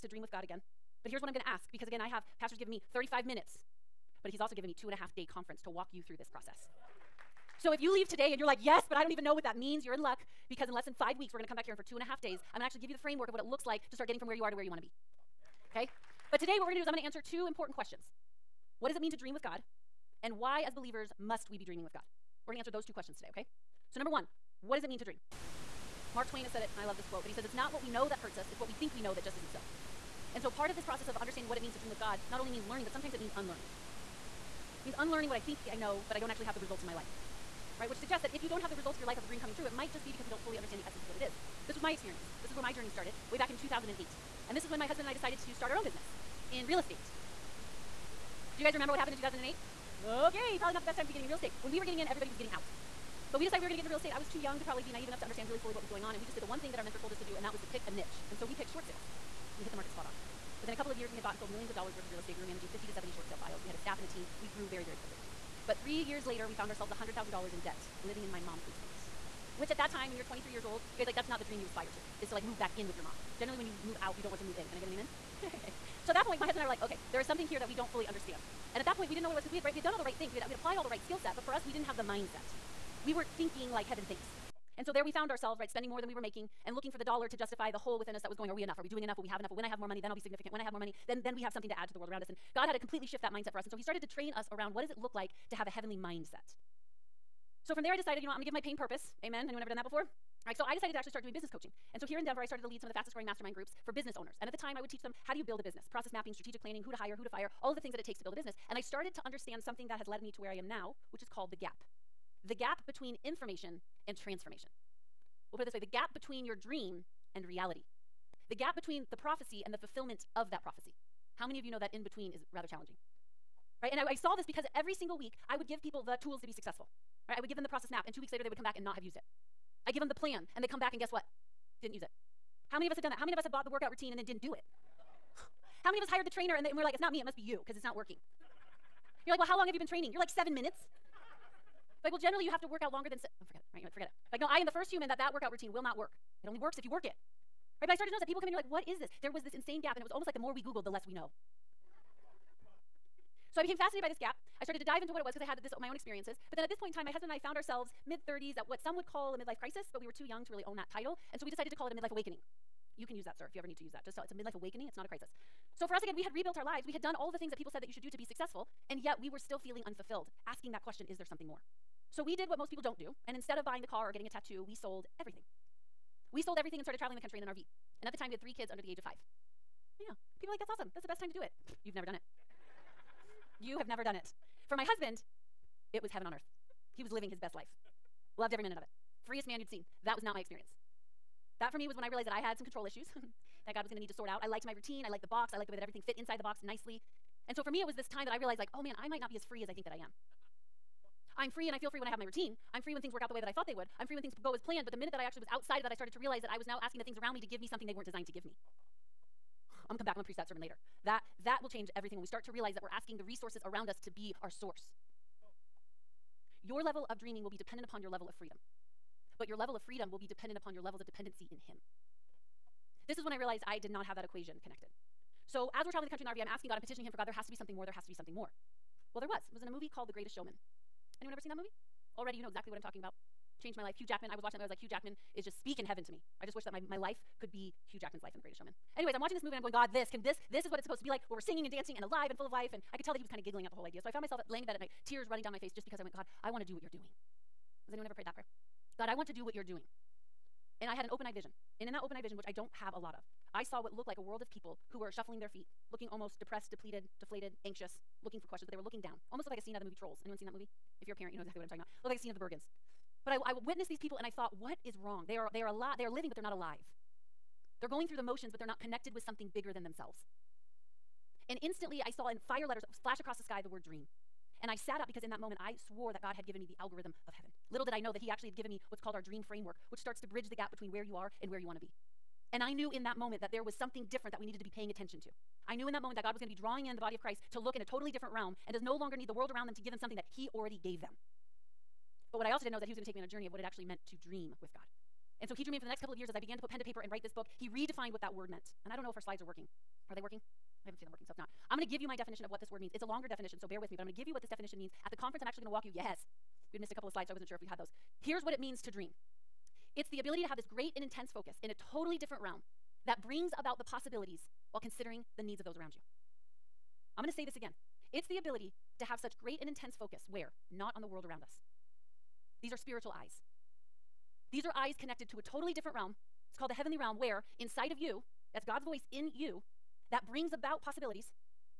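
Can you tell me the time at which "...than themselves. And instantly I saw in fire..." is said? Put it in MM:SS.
04:29.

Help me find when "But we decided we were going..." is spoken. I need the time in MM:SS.
00:53.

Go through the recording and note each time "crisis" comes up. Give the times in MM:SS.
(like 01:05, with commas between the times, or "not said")
02:39, 02:45.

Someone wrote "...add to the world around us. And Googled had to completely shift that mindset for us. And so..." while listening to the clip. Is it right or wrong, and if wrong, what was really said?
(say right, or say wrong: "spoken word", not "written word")
wrong: "God", not "Googled".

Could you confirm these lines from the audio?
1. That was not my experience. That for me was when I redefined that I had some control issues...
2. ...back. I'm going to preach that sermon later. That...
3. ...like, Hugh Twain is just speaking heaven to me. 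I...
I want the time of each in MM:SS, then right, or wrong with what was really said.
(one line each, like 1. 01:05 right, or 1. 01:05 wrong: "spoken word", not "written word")
1. 03:10 wrong: "realized", not "redefined"
2. 03:30 right
3. 03:54 wrong: "Jackman", not "Twain".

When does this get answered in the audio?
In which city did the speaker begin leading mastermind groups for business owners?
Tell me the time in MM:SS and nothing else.
01:42.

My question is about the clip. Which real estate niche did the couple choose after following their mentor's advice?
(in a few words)
Short sales.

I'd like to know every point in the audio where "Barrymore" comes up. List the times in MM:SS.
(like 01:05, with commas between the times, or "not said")
not said.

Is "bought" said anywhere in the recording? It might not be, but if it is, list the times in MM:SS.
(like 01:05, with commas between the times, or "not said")
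01:01, 02:13.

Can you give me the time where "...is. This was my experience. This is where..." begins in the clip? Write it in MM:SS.
00:41.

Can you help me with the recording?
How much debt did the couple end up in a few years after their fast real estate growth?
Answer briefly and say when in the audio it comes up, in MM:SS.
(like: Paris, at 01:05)
$100,000, at 01:06.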